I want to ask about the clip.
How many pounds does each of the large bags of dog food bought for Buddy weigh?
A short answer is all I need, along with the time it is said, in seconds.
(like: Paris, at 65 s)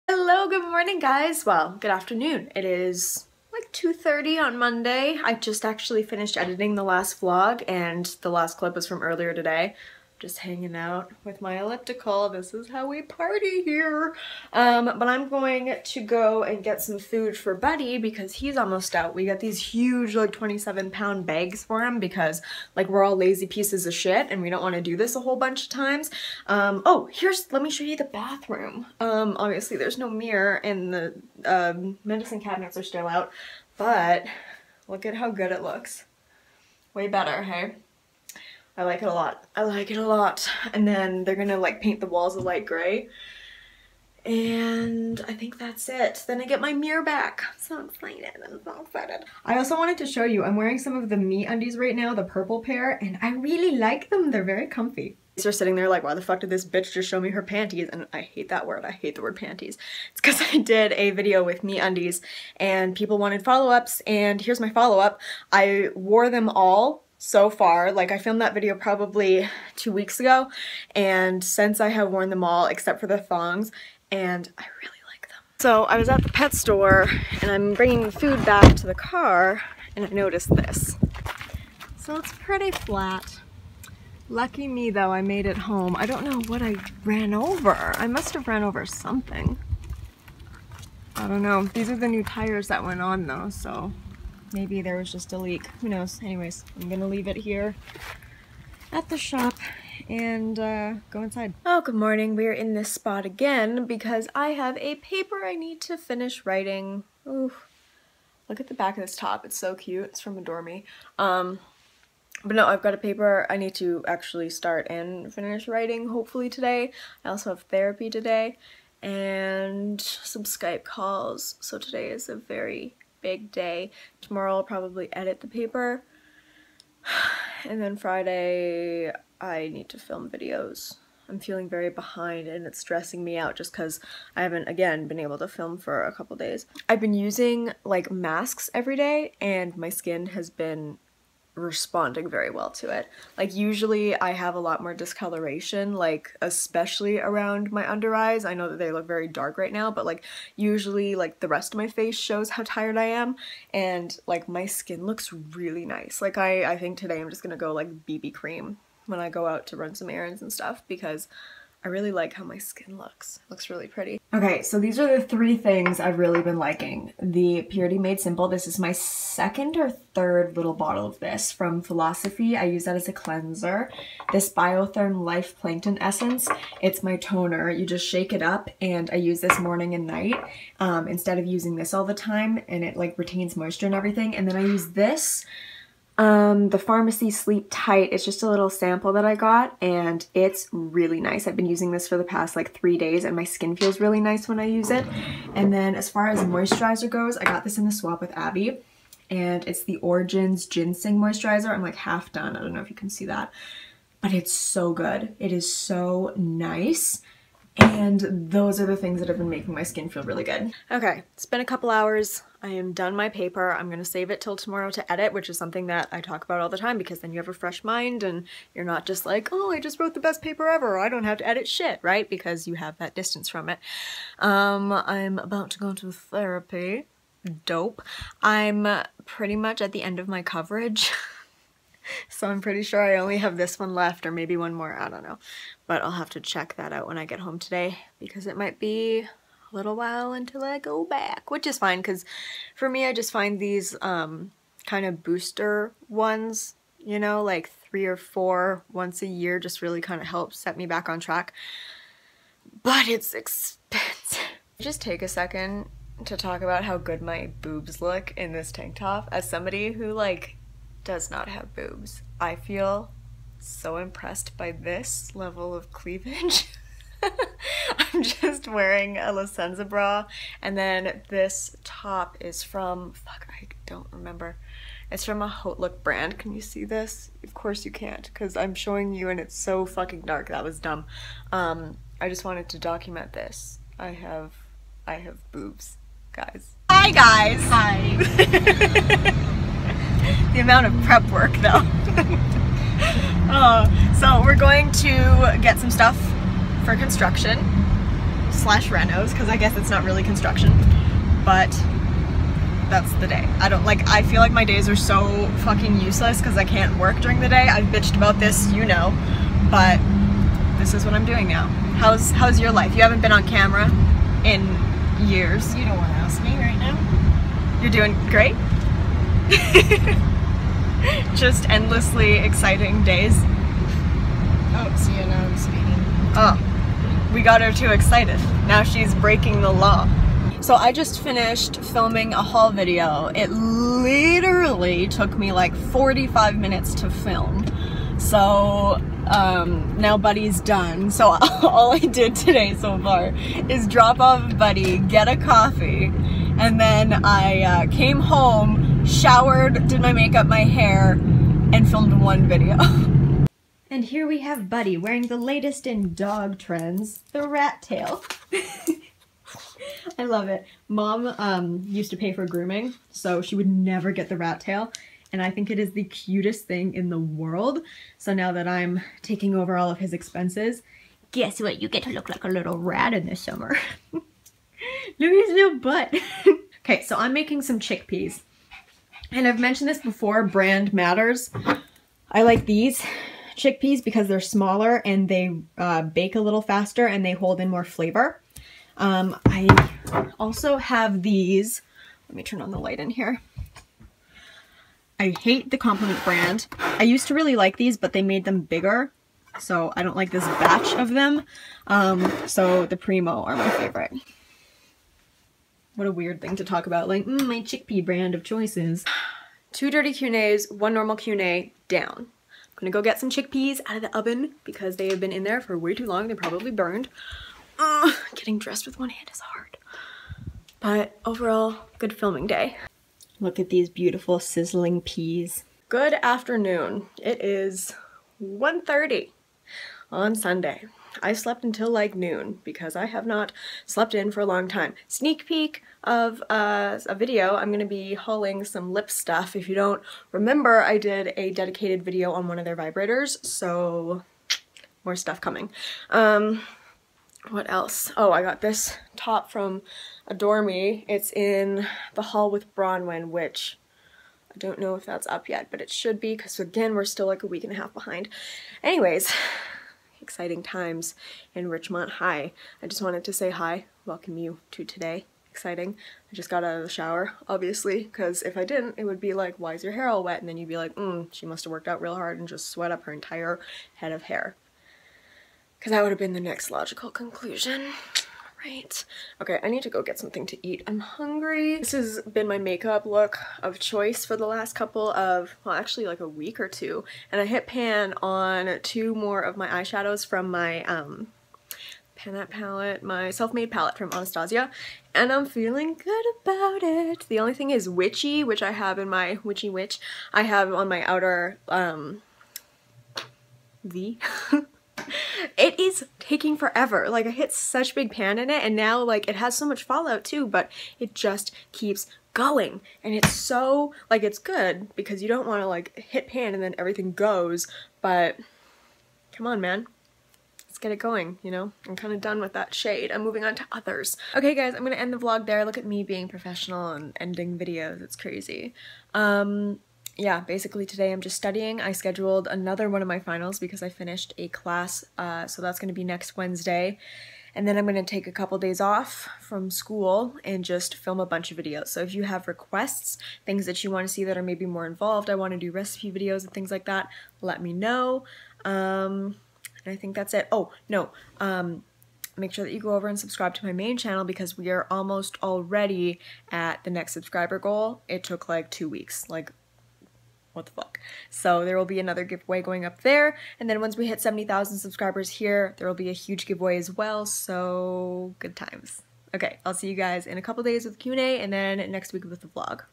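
27, at 20 s.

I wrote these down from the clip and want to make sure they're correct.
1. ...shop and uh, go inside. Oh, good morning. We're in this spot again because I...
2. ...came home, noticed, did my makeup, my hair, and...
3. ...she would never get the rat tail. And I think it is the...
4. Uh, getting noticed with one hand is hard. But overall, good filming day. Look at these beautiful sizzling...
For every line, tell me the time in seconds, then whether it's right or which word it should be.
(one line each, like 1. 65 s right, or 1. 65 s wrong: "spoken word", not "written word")
1. 99 s right
2. 347 s wrong: "showered", not "noticed"
3. 363 s right
4. 417 s wrong: "dressed", not "noticed".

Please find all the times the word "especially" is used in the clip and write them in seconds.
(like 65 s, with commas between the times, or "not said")
146 s.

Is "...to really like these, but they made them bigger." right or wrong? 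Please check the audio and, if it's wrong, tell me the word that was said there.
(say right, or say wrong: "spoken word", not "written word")
right.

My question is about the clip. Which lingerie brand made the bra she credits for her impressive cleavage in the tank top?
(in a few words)
La Senza.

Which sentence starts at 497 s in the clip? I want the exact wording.
The only thing is Witchy, which I have in my Witchy Witch, I have on my outer um, V.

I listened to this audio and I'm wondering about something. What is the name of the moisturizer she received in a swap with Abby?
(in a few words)
Origins GinZing Moisturizer.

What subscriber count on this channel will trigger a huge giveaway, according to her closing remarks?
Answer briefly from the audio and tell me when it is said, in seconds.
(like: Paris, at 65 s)
70,000, at 564 s.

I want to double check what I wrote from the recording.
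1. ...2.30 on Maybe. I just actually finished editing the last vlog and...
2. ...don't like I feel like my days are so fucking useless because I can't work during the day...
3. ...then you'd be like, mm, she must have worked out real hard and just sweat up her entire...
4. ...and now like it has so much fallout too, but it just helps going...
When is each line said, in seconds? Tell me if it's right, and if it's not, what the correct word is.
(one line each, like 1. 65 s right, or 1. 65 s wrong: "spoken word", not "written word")
1. 3 s wrong: "Monday", not "Maybe"
2. 303 s right
3. 470 s right
4. 508 s wrong: "keeps", not "helps".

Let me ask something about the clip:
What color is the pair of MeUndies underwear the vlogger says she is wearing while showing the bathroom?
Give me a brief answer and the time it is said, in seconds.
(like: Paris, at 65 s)
Purple, at 52 s.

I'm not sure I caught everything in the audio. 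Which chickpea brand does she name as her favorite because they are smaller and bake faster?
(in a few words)
Primo.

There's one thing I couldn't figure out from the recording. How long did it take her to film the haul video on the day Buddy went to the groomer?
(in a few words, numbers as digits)
45 minutes.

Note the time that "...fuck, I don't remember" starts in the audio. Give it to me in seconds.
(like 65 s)
273 s.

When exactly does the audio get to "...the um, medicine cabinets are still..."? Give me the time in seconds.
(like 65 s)
30 s.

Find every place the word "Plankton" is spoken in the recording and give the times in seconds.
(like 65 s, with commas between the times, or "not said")
175 s.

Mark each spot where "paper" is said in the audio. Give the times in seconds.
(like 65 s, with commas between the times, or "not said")
104 s, 112 s, 125 s, 213 s, 220 s.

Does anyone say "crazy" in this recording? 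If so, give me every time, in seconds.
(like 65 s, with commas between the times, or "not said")
528 s.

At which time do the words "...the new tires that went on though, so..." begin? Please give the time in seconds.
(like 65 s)
91 s.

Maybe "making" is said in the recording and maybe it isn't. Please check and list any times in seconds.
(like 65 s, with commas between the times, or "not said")
209 s, 377 s.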